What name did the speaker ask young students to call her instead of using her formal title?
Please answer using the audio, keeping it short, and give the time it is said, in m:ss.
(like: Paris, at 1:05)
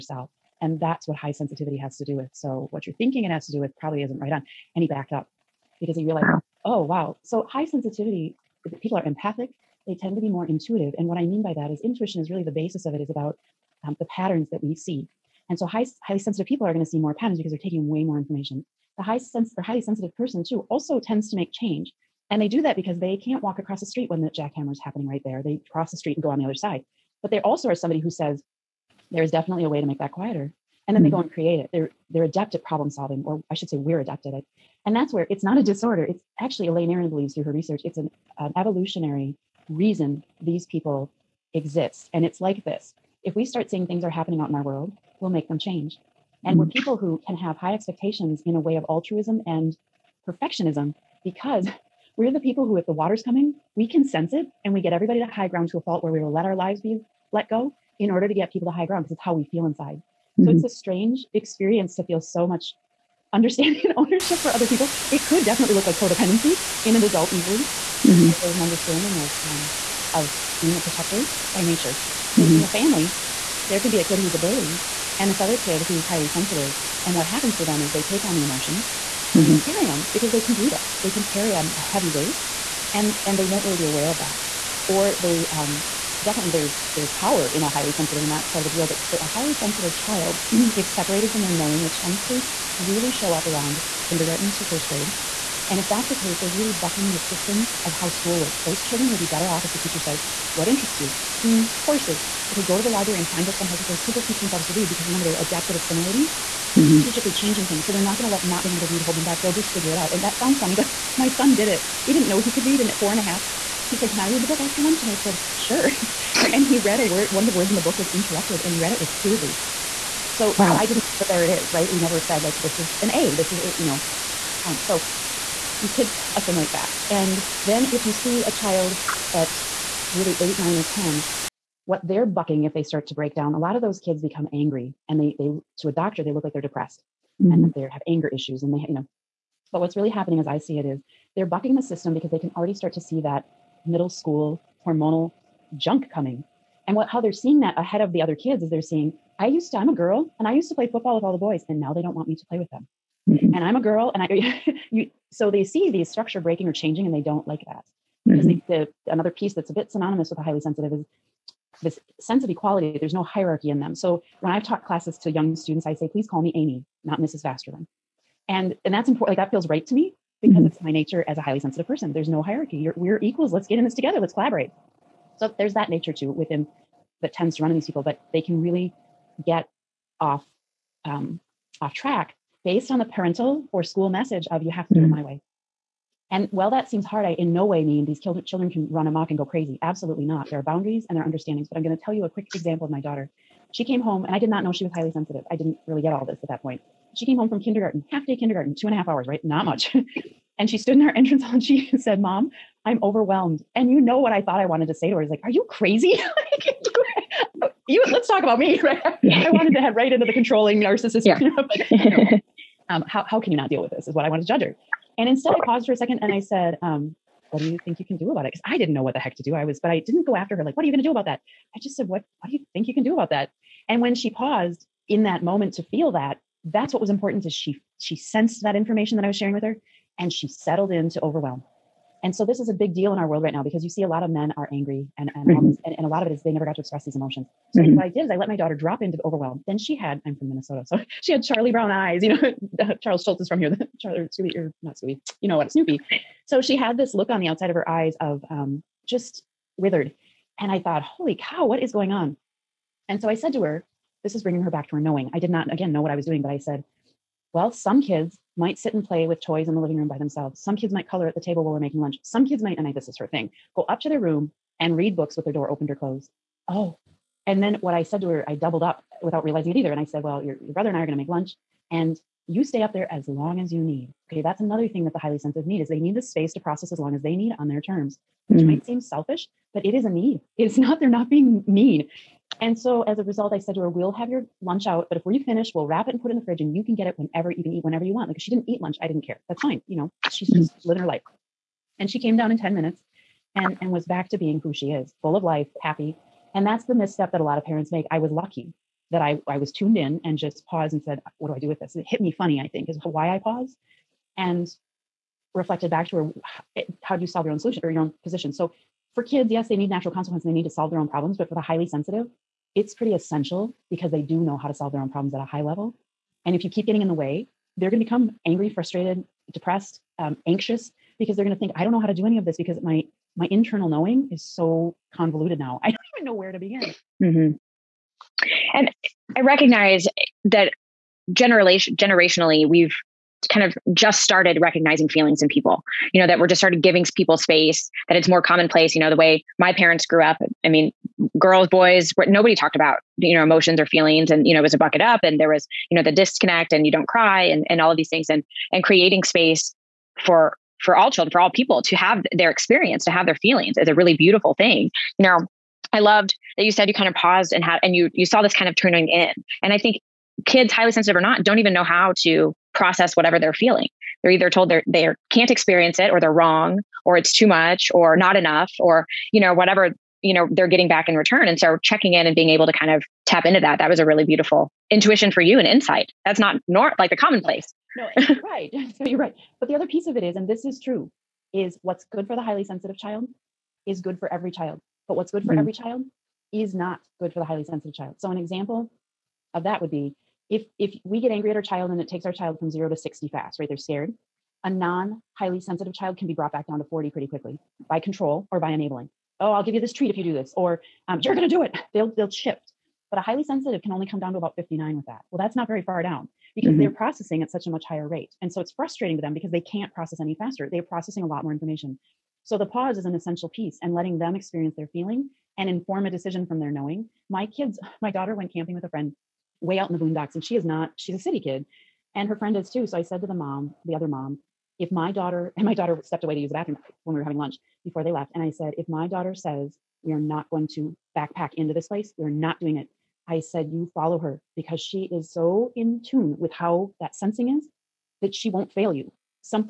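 Amy, at 2:46.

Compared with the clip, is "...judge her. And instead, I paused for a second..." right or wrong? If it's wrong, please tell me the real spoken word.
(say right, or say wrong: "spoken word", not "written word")
right.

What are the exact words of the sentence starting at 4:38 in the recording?
might seem selfish, but it is a need.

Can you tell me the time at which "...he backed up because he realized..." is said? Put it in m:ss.
0:04.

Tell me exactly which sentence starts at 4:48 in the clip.
Like if she didn't eat lunch, I didn't care.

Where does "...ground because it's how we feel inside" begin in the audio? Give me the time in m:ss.
0:58.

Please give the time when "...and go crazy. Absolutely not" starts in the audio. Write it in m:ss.
3:09.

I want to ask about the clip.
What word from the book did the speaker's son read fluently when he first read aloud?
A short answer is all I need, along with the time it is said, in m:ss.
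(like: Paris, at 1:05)
interrupted, at 1:58.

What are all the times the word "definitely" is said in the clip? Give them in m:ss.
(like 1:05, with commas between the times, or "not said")
0:29, 1:05, 1:26.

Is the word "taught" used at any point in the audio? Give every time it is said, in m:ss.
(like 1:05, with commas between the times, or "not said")
2:44.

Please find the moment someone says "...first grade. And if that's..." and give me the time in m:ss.
1:34.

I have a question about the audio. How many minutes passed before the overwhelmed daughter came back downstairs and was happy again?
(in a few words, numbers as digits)
10.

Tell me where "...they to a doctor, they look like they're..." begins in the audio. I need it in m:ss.
2:15.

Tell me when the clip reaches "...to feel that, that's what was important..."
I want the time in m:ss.
3:45.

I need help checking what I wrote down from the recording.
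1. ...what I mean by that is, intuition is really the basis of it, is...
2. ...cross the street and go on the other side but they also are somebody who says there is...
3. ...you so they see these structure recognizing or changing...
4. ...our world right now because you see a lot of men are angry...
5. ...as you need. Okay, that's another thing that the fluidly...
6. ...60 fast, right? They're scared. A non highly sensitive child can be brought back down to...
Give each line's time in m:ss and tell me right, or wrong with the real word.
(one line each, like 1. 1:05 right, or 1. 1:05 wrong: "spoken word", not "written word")
1. 0:11 right
2. 0:25 right
3. 2:34 wrong: "breaking", not "recognizing"
4. 3:53 right
5. 4:33 wrong: "highly", not "fluidly"
6. 6:32 right.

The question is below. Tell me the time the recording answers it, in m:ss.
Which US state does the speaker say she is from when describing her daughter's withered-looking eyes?
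4:00.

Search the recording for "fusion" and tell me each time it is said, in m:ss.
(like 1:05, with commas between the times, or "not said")
not said.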